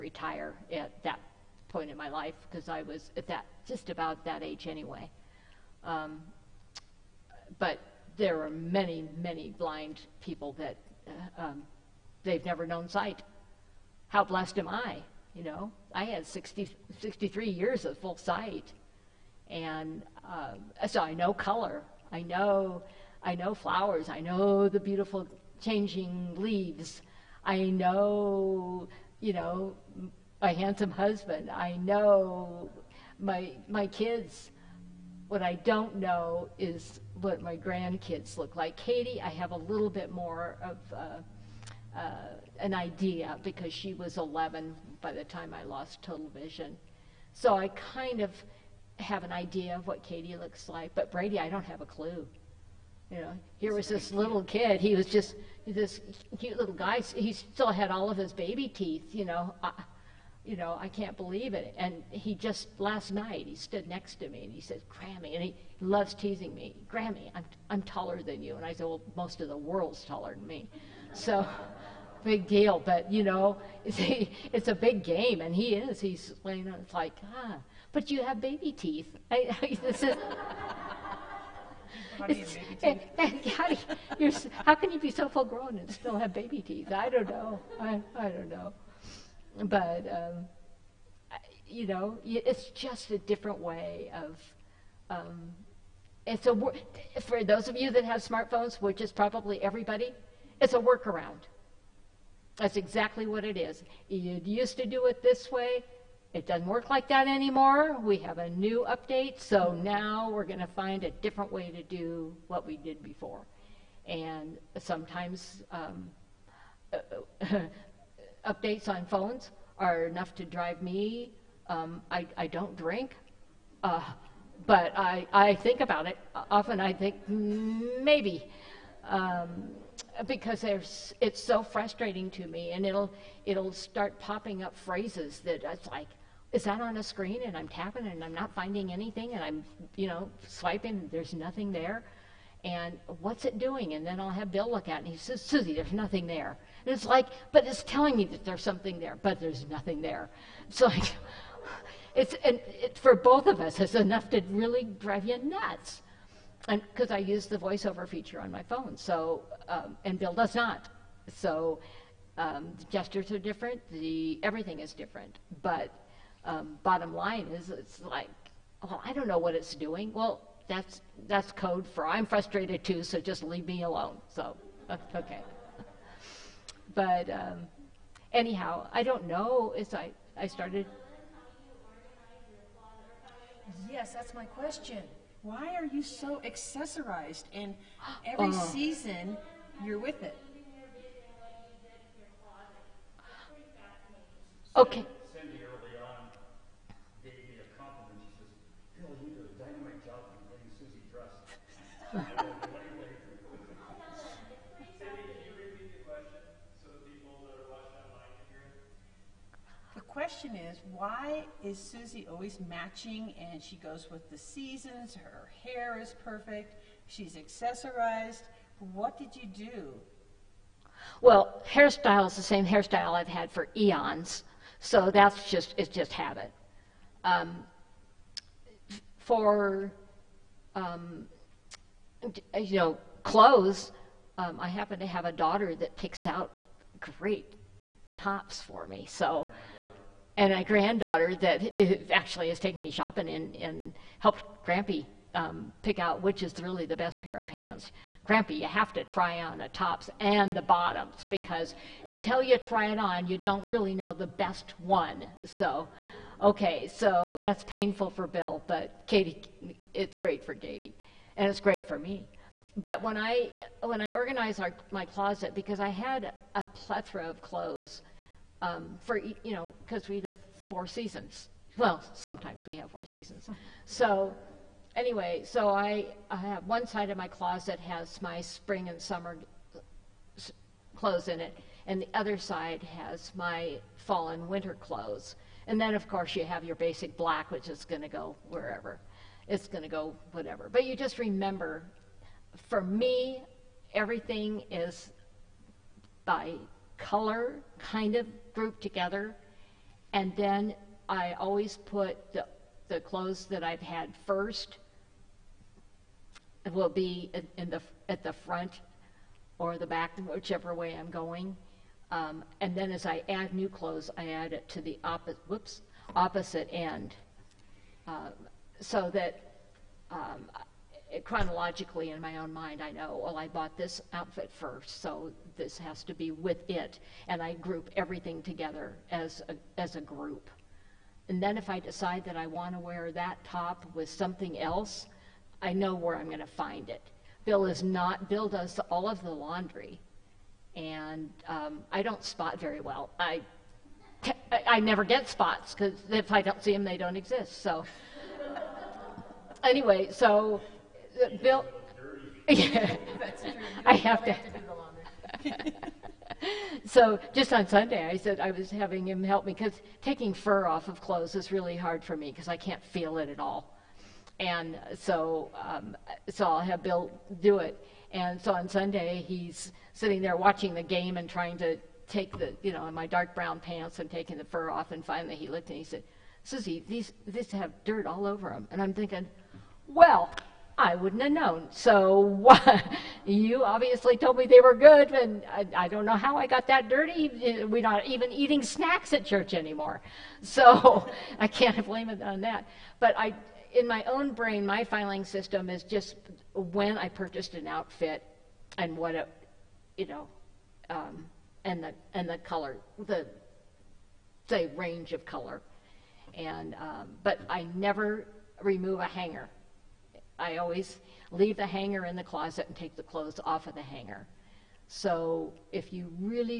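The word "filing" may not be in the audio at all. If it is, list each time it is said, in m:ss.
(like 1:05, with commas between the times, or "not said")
6:34.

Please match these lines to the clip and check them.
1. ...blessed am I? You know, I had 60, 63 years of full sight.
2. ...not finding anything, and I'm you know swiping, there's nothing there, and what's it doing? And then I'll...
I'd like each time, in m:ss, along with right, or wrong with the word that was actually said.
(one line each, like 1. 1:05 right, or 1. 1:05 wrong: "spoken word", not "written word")
1. 0:14 right
2. 2:18 right.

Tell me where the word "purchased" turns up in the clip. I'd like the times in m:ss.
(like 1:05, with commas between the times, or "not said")
6:37.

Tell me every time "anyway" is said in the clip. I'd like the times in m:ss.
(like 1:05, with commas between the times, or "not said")
0:04, 4:34, 5:49.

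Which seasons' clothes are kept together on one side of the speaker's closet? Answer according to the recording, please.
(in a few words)
Spring and summer.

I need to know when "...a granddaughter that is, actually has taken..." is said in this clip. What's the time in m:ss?
4:00.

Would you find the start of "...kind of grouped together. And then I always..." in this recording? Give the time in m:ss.
4:57.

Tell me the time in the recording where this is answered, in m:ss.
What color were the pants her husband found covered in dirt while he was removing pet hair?
6:13.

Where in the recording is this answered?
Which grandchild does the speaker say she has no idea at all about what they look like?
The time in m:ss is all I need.
0:51.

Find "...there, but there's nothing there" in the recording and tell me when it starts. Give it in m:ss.
2:28.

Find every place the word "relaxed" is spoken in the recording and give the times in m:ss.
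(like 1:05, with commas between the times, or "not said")
not said.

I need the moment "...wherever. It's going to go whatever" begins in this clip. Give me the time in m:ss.
4:48.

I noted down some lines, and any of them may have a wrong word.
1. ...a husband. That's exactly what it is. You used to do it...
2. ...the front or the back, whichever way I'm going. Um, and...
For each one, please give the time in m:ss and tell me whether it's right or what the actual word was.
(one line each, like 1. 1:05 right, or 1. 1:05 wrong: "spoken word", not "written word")
1. 1:40 wrong: "workaround", not "husband"
2. 5:08 right.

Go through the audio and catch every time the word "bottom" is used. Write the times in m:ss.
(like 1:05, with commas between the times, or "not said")
2:46, 4:10.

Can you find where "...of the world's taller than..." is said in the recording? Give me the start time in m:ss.
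1:09.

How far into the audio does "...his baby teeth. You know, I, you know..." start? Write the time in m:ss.
0:58.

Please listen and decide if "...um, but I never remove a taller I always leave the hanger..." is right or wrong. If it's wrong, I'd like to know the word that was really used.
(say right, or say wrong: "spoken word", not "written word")
wrong: "hanger", not "taller".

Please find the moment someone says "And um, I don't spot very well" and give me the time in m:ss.
5:40.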